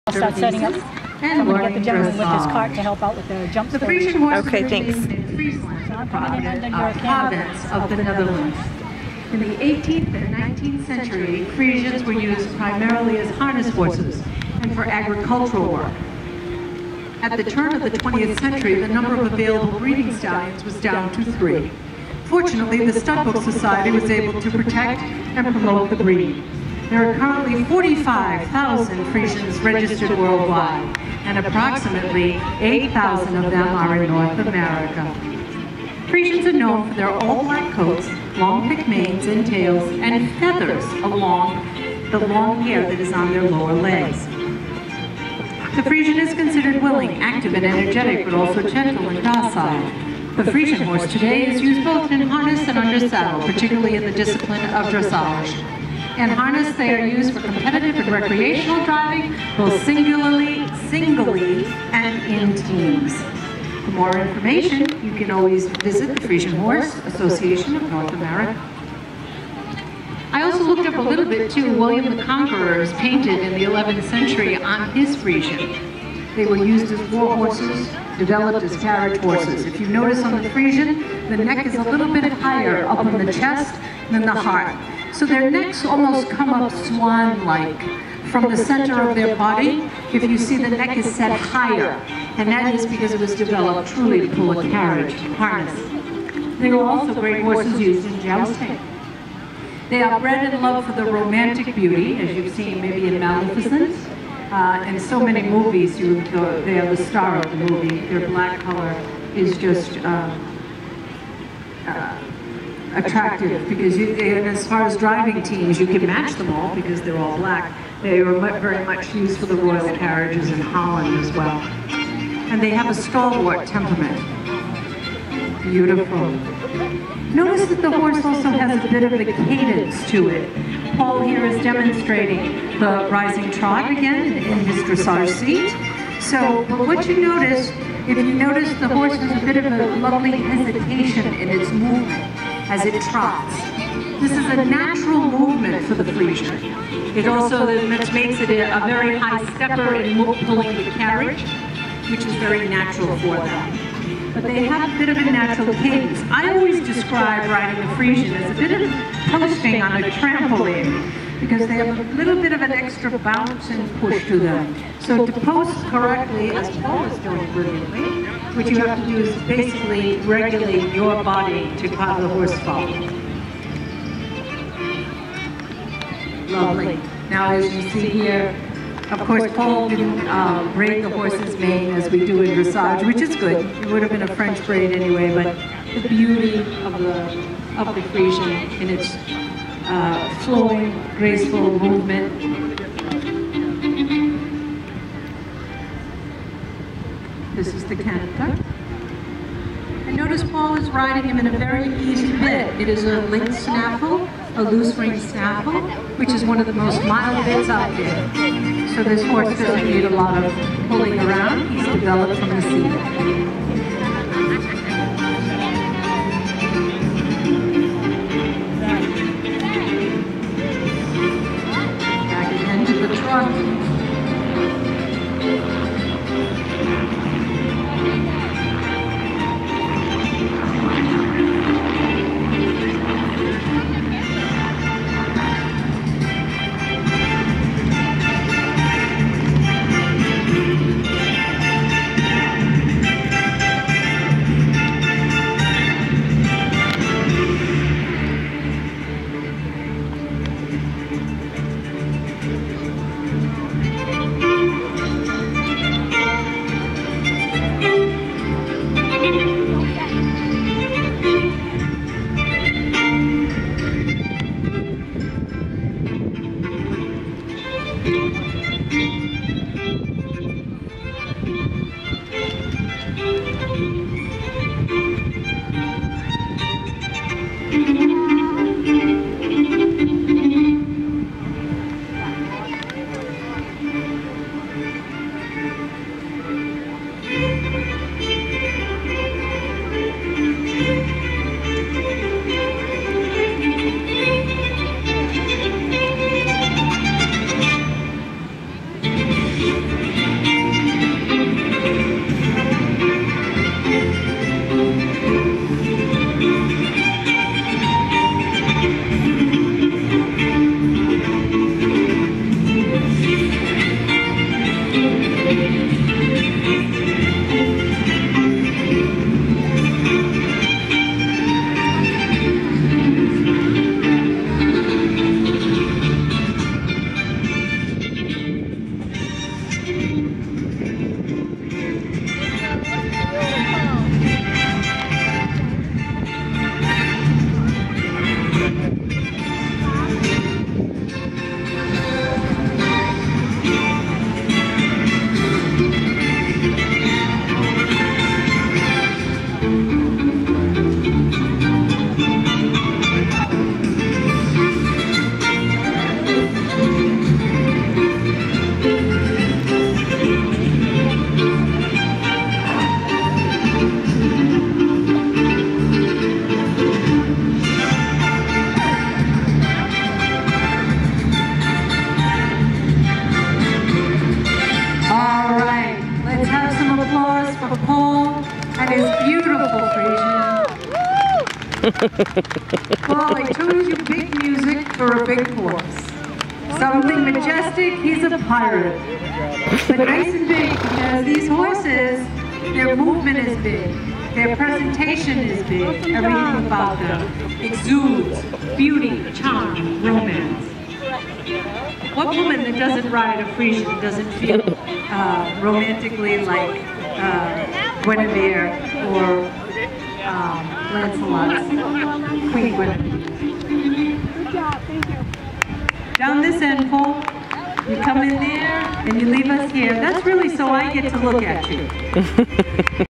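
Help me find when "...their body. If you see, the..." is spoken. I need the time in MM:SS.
01:29.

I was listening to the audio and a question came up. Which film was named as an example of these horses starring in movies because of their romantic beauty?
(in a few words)
Maleficent.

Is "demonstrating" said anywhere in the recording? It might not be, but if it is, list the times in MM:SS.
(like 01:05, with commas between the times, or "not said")
02:11.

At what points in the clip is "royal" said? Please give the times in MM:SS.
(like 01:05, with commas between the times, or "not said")
01:59.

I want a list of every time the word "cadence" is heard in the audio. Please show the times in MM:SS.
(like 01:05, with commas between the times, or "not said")
02:09, 02:35.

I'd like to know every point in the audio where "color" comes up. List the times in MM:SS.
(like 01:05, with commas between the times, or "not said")
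01:48.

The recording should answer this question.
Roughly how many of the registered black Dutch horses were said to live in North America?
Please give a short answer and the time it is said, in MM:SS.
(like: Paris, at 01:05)
8,000, at 00:32.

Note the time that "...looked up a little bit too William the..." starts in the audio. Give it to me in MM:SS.
01:10.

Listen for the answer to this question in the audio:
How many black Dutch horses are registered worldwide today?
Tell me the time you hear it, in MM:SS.
00:27.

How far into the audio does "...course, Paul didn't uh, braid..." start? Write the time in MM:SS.
02:59.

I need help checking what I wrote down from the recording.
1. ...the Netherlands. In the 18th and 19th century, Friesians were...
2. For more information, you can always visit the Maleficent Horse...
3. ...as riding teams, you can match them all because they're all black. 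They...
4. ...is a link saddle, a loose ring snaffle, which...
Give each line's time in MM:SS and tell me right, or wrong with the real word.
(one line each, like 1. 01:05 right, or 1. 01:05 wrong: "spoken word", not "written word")
1. 00:07 right
2. 01:03 wrong: "Friesian", not "Maleficent"
3. 01:54 wrong: "driving", not "riding"
4. 03:22 wrong: "snaffle", not "saddle".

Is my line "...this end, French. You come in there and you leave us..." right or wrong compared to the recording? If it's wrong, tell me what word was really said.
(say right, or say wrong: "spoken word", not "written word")
wrong: "Cole", not "French".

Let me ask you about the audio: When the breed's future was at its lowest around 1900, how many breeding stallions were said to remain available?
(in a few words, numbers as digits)
3.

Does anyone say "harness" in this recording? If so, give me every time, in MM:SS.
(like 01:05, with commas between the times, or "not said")
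00:13, 00:52, 00:56, 01:35.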